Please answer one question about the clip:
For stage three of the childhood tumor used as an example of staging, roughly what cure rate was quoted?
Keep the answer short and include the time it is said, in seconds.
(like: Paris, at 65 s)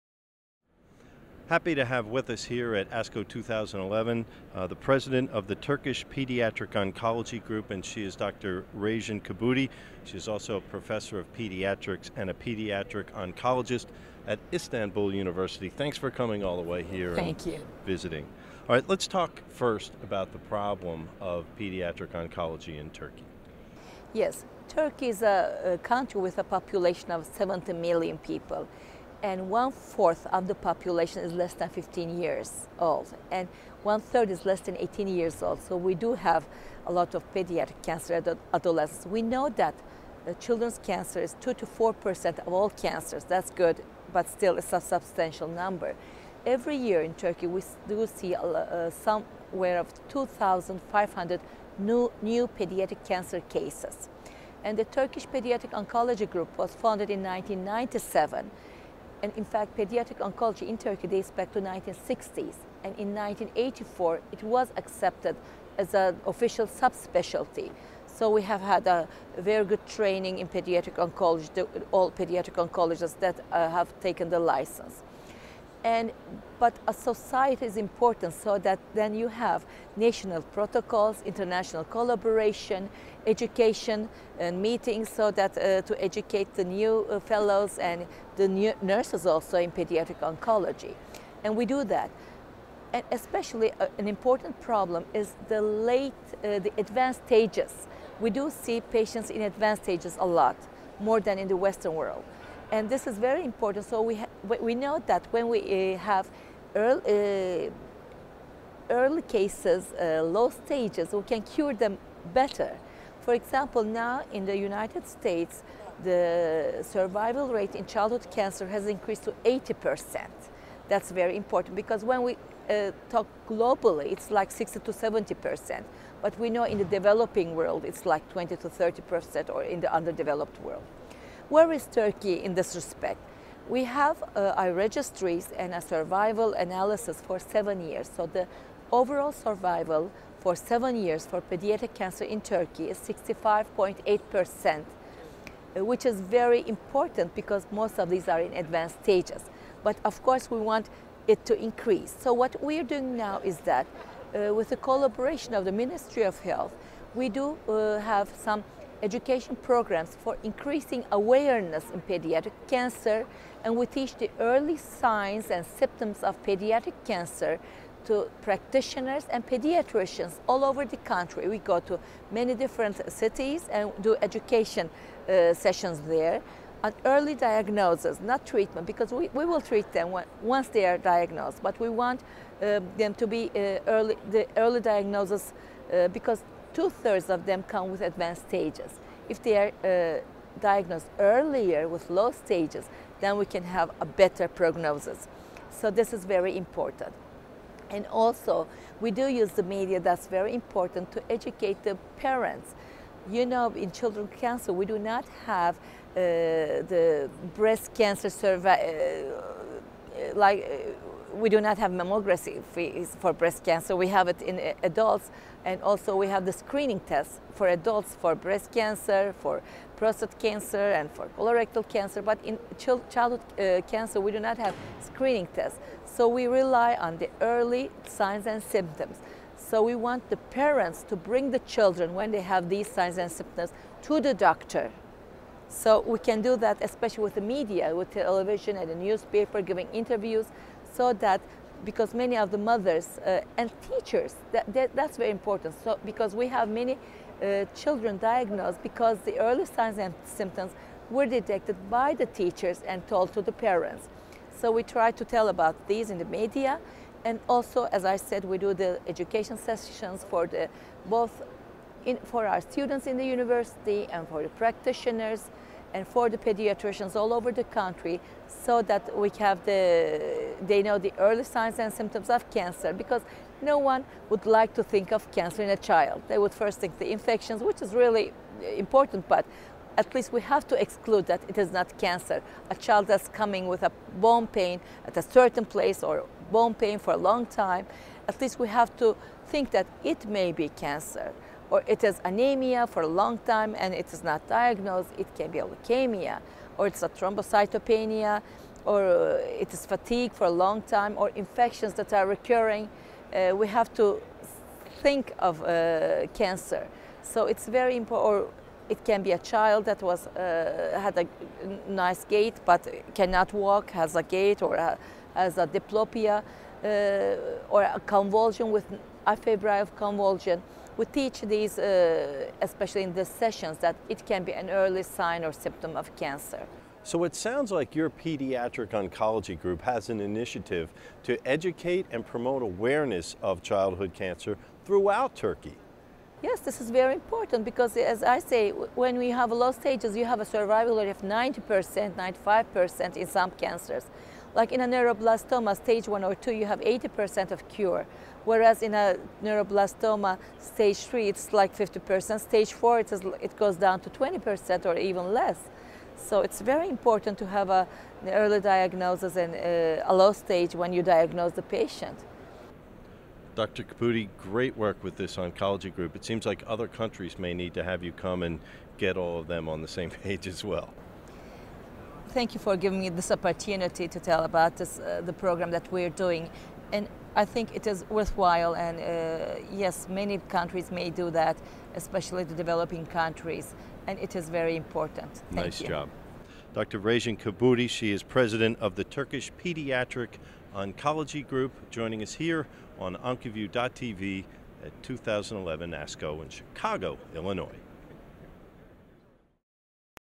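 50%, at 351 s.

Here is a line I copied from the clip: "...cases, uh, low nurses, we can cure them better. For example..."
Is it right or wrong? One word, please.
wrong.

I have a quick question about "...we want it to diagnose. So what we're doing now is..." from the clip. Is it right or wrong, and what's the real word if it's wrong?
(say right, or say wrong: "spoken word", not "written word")
wrong: "increase", not "diagnose".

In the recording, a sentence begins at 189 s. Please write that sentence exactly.
If they are uh, diagnosed earlier with low stages, then we can have a better prognosis.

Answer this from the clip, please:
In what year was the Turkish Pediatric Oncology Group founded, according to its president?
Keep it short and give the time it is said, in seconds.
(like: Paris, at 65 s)
1997, at 57 s.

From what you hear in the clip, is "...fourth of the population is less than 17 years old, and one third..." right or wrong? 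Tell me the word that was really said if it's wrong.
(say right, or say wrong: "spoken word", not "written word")
wrong: "15", not "17".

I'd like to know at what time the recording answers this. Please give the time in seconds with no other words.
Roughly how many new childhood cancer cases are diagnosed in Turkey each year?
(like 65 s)
50 s.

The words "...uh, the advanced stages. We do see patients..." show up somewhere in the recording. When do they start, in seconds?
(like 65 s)
96 s.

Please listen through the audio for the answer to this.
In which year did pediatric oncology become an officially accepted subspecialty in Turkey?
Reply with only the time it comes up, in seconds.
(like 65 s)
63 s.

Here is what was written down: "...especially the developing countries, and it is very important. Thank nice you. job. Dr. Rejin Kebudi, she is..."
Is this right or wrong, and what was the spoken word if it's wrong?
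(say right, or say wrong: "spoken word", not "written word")
right.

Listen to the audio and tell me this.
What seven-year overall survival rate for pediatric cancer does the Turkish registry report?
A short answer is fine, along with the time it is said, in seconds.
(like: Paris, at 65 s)
65.8%, at 142 s.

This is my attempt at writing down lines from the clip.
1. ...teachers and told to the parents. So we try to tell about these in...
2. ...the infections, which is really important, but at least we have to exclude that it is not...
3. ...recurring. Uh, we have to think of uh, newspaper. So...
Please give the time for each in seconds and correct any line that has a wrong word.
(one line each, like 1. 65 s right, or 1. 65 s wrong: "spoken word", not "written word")
1. 252 s right
2. 276 s right
3. 302 s wrong: "cancer", not "newspaper".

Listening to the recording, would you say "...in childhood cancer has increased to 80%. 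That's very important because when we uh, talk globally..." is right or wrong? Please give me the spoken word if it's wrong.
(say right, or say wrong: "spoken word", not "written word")
right.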